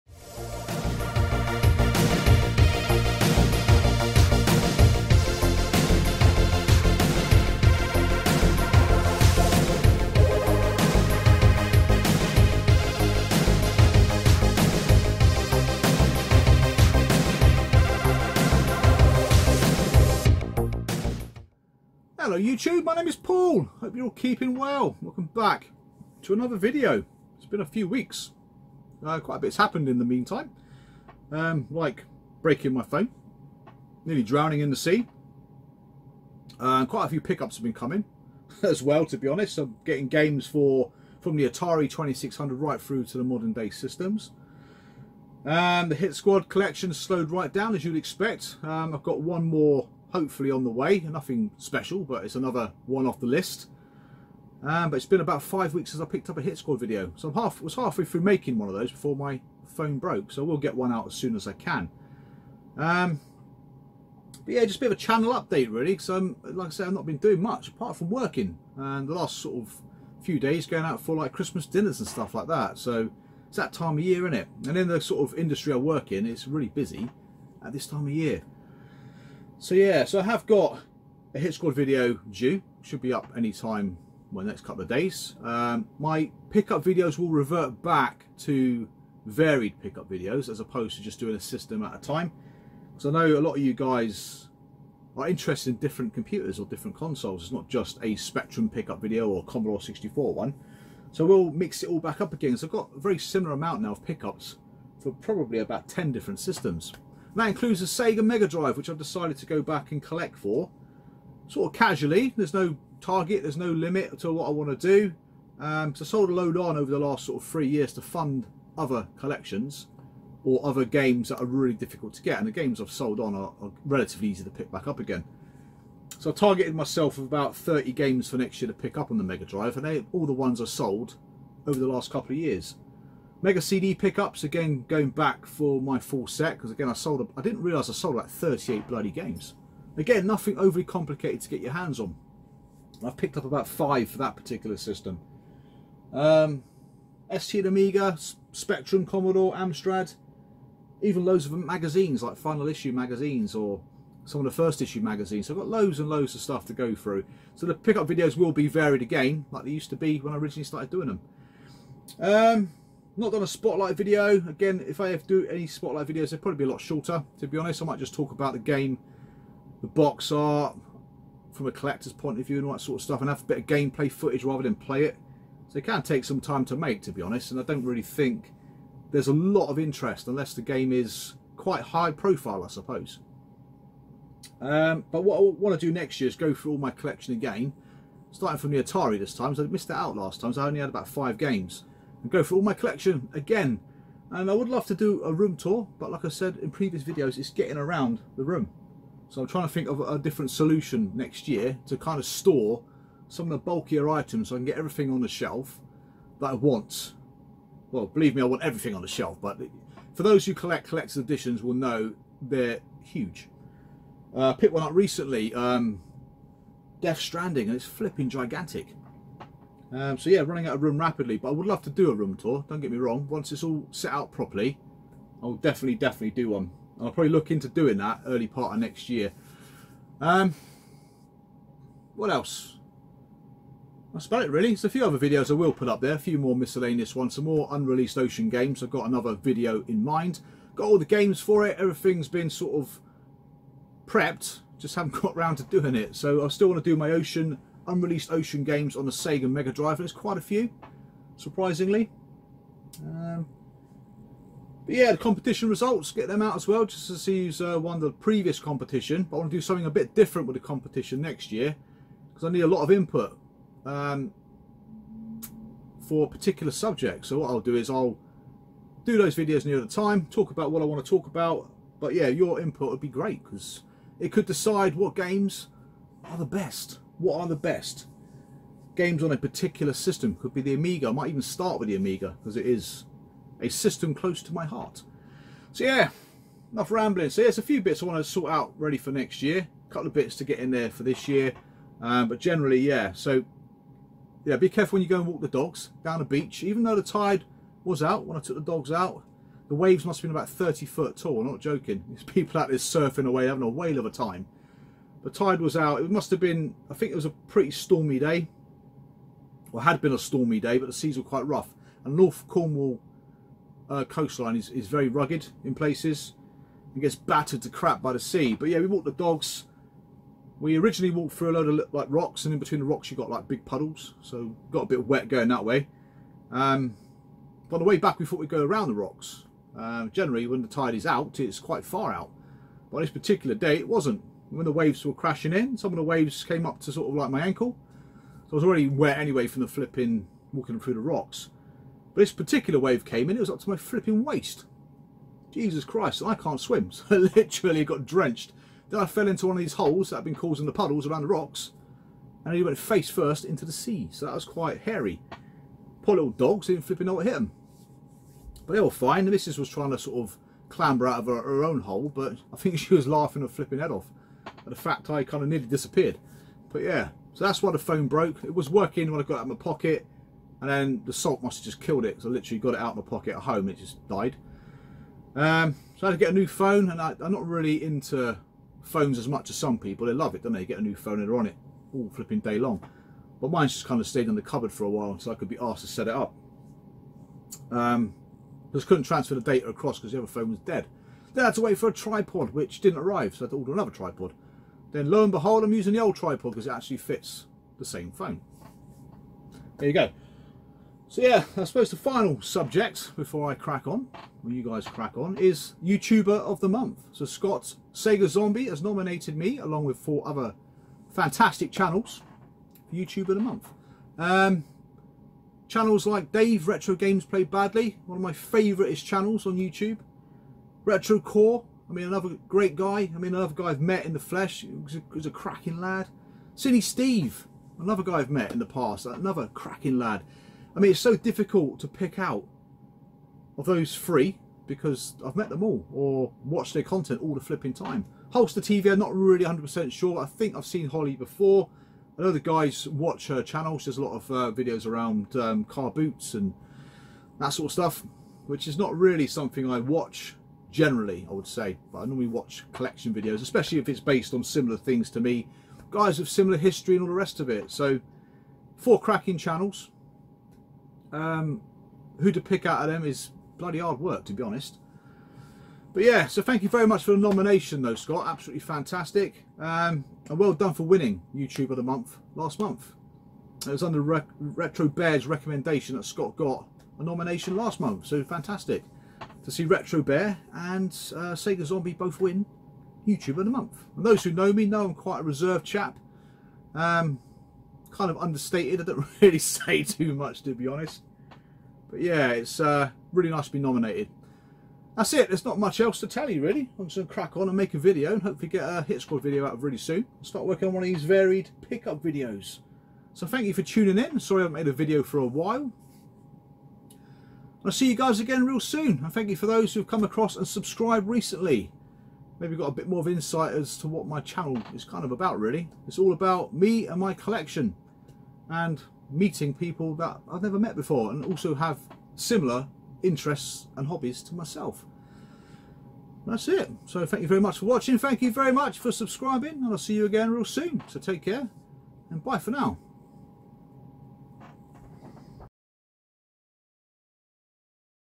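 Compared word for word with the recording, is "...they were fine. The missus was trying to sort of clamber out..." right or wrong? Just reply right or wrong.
right.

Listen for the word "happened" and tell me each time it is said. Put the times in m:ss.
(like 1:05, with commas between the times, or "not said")
0:29.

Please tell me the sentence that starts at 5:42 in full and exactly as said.
But this particular wave came in, it was up to my flipping waist.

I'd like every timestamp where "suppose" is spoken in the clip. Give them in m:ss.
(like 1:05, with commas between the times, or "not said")
3:02, 6:41.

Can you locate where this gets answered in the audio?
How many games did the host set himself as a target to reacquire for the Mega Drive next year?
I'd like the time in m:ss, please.
2:07.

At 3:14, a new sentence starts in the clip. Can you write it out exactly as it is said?
And I would love to do a room tour, but like I said in previous videos, it's getting around the room.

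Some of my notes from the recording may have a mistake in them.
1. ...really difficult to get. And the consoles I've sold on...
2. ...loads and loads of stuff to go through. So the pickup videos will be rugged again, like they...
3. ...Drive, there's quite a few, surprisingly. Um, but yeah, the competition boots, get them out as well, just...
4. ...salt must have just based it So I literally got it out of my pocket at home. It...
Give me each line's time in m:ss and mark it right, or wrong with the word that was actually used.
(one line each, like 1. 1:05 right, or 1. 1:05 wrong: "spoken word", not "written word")
1. 2:01 wrong: "games", not "consoles"
2. 2:35 wrong: "varied", not "rugged"
3. 4:09 wrong: "results", not "boots"
4. 6:11 wrong: "killed", not "based".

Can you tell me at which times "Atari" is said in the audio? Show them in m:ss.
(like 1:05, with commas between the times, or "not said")
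0:41, 3:08.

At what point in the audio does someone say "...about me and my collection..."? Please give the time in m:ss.
8:36.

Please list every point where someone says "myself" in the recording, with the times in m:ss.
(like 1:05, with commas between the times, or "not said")
2:06, 8:44.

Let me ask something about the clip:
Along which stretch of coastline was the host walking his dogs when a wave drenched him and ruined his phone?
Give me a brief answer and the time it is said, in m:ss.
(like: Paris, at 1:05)
North Cornwall, at 5:12.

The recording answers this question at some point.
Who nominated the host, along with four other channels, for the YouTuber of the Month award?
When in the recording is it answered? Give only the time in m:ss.
6:47.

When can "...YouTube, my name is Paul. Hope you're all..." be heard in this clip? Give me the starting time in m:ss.
0:22.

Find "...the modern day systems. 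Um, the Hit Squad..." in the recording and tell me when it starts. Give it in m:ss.
0:43.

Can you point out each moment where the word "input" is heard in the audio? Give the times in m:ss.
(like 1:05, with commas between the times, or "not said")
4:22, 4:32.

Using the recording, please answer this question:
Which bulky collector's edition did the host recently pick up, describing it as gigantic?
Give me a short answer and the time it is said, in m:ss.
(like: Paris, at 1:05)
Death Stranding, at 3:37.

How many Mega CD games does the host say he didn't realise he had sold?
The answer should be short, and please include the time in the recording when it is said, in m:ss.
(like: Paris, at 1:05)
38, at 2:18.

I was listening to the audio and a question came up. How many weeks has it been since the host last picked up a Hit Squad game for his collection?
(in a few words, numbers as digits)
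5.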